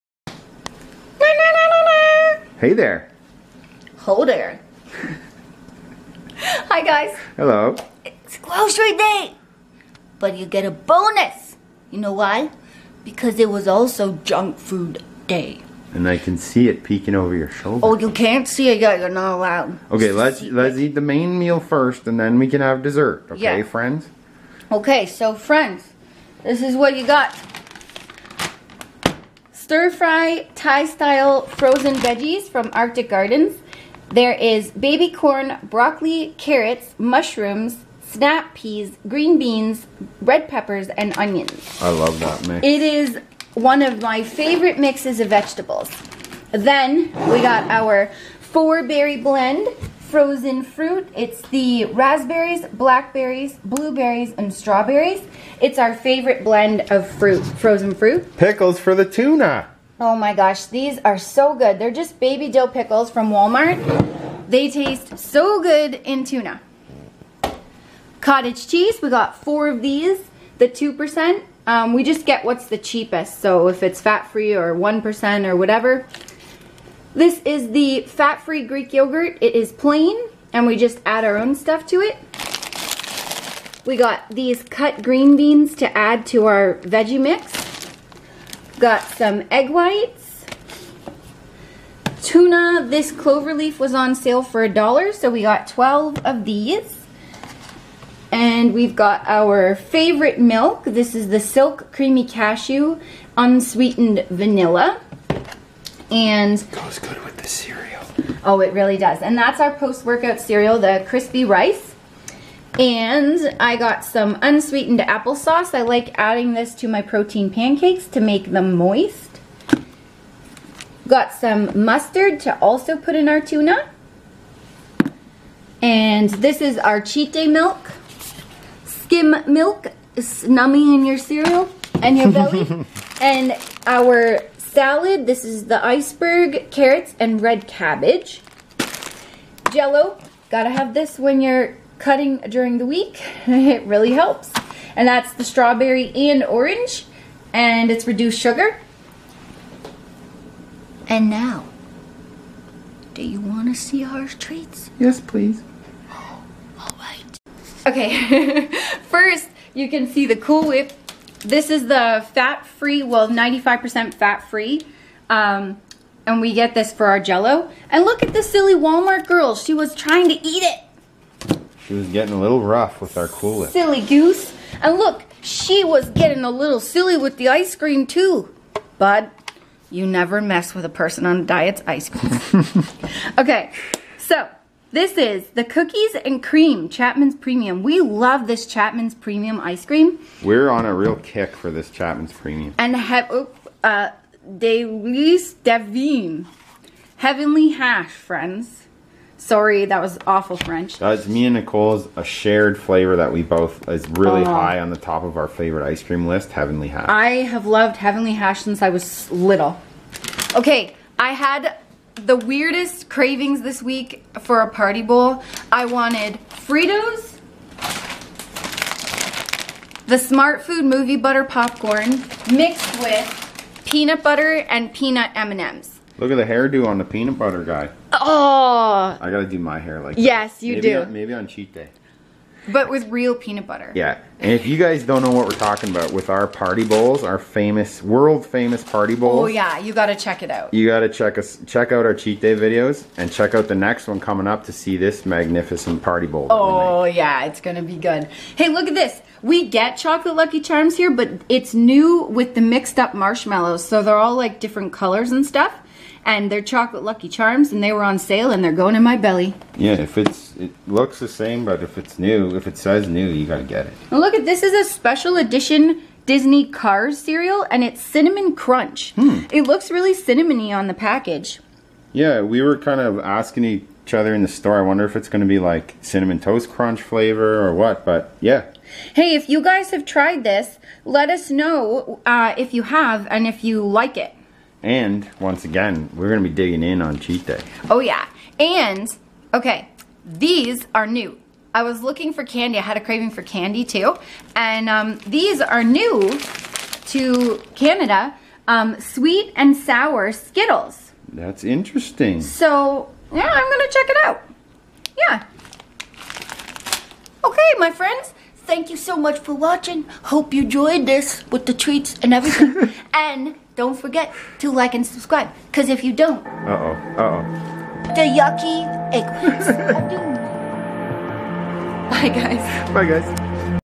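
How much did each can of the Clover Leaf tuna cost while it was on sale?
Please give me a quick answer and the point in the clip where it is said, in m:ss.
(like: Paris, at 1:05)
a dollar, at 1:34.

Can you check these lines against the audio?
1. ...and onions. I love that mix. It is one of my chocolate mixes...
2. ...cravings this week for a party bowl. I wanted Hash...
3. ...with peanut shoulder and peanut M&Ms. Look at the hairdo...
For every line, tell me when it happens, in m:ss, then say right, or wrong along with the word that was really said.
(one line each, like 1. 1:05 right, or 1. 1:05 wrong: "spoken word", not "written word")
1. 0:40 wrong: "favorite", not "chocolate"
2. 3:33 wrong: "Fritos", not "Hash"
3. 3:42 wrong: "butter", not "shoulder".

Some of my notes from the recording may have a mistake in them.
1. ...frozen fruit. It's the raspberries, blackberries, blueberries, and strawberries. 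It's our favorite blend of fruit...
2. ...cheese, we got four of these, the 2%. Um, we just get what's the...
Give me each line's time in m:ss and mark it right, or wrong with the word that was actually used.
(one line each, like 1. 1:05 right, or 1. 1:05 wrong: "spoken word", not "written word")
1. 0:50 right
2. 1:08 right.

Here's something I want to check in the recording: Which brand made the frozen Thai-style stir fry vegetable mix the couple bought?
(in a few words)
Arctic Gardens.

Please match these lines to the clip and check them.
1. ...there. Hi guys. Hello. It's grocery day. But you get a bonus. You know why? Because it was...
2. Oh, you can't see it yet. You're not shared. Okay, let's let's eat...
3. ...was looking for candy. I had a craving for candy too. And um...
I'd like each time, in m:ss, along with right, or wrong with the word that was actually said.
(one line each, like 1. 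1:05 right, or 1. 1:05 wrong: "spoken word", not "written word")
1. 0:04 right
2. 0:17 wrong: "allowed", not "shared"
3. 4:51 right.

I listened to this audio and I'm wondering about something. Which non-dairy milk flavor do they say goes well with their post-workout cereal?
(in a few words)
Silk Creamy Cashew Unsweetened Vanilla.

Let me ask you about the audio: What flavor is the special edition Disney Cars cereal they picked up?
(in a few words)
cinnamon crunch.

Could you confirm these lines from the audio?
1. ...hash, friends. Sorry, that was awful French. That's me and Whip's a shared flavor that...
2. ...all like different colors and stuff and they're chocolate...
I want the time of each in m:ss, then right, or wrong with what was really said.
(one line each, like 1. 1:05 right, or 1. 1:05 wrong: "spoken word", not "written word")
1. 3:17 wrong: "Nicole", not "Whip"
2. 4:14 right.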